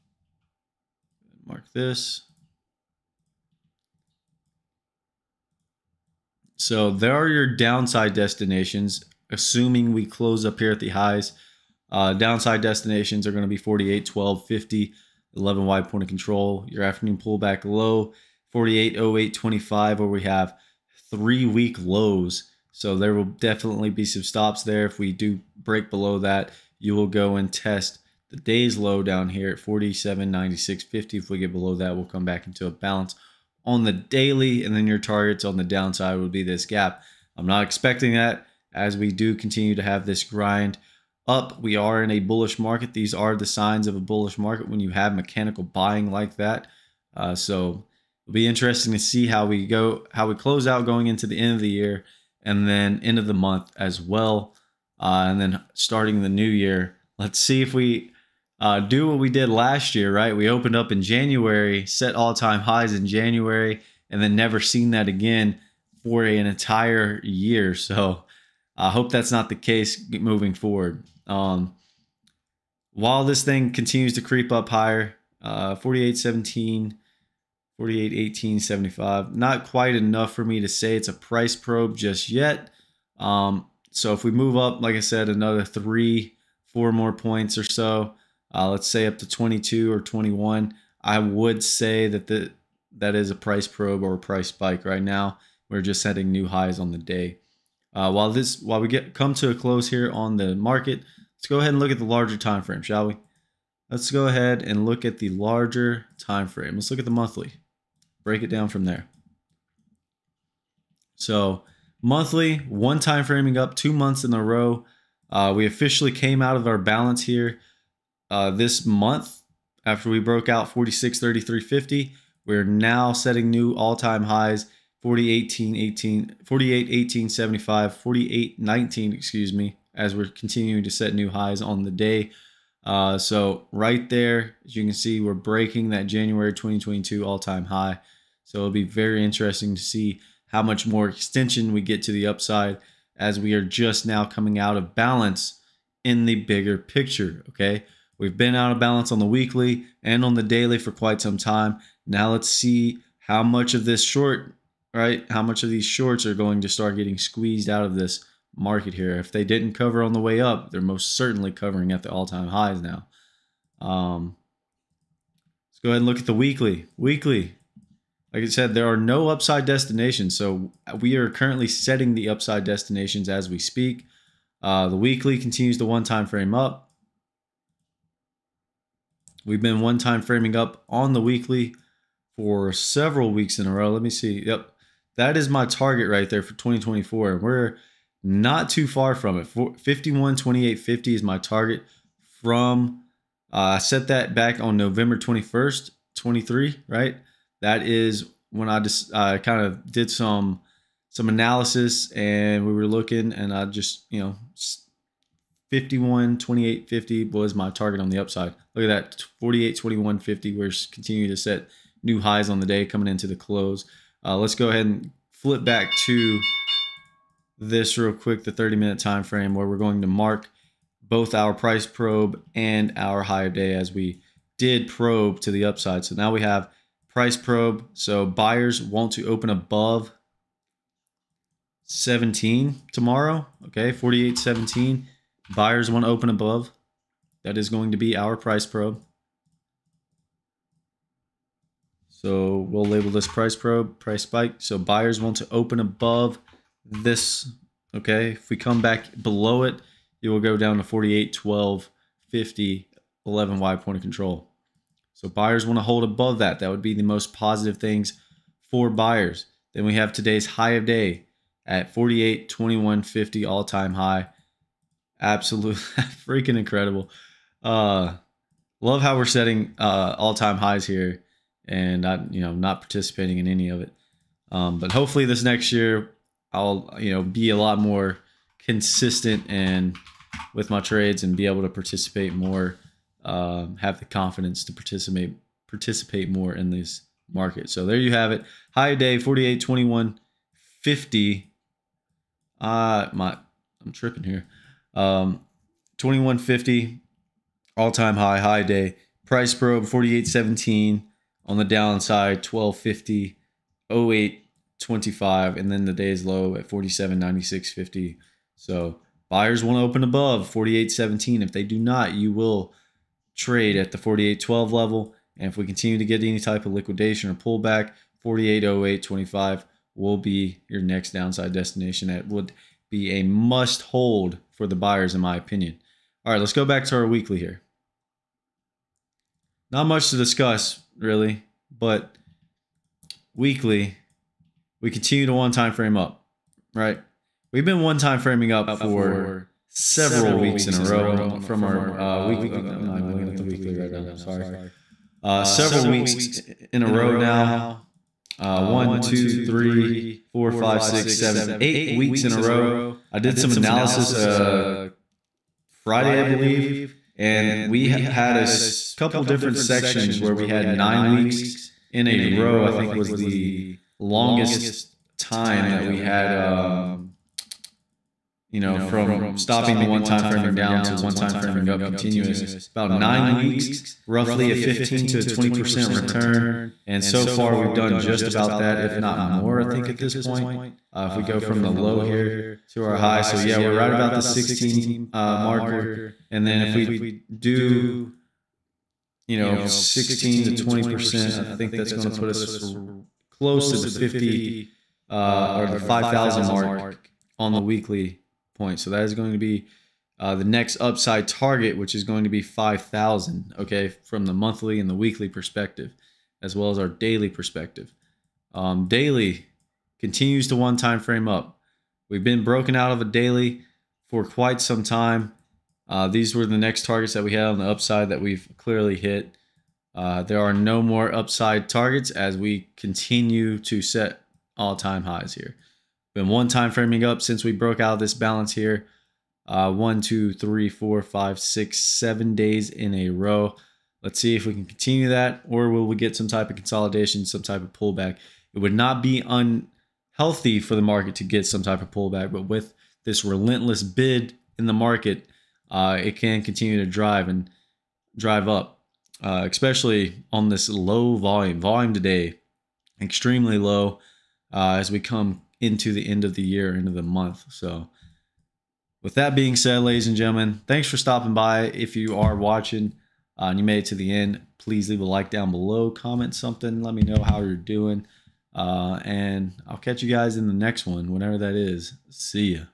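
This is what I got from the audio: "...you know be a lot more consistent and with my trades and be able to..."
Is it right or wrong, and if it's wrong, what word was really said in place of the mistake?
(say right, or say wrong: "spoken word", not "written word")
right.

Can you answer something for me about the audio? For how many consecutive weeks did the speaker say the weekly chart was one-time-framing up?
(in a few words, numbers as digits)
8.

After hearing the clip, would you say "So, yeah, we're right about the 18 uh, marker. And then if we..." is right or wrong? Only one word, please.
wrong.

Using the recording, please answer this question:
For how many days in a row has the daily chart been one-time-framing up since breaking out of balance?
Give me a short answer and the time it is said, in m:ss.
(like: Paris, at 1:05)
7, at 7:11.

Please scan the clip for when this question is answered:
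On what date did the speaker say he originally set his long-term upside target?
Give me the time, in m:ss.
3:14.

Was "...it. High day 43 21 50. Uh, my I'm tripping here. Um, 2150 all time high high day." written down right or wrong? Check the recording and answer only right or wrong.
wrong.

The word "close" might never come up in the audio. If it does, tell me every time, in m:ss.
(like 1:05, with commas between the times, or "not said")
0:10, 0:50, 1:39, 3:33, 6:33.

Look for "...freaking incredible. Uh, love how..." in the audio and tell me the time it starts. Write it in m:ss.
4:26.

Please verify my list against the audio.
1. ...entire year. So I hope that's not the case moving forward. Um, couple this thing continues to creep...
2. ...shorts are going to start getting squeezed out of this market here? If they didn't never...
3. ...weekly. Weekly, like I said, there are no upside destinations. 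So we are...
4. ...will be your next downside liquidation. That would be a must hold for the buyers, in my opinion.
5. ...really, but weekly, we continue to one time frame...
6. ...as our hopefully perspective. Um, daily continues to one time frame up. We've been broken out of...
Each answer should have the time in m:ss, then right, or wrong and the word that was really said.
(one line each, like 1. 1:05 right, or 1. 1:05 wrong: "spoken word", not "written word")
1. 1:06 wrong: "while", not "couple"
2. 2:35 wrong: "cover", not "never"
3. 2:46 right
4. 5:19 wrong: "destination", not "liquidation"
5. 5:30 right
6. 6:46 wrong: "daily", not "hopefully".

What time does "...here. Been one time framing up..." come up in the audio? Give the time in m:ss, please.
7:05.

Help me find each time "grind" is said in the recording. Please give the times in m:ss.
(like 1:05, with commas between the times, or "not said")
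0:40.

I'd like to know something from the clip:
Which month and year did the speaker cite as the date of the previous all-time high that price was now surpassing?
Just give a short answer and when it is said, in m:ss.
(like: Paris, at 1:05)
January 2022, at 2:16.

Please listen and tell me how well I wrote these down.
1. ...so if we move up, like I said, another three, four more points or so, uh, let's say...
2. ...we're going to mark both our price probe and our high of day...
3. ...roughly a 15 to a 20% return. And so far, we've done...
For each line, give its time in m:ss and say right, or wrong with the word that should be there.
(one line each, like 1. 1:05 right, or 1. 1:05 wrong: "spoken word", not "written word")
1. 1:23 right
2. 3:39 right
3. 6:14 right.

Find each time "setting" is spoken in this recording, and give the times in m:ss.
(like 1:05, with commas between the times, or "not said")
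1:36, 2:03, 2:51, 4:29.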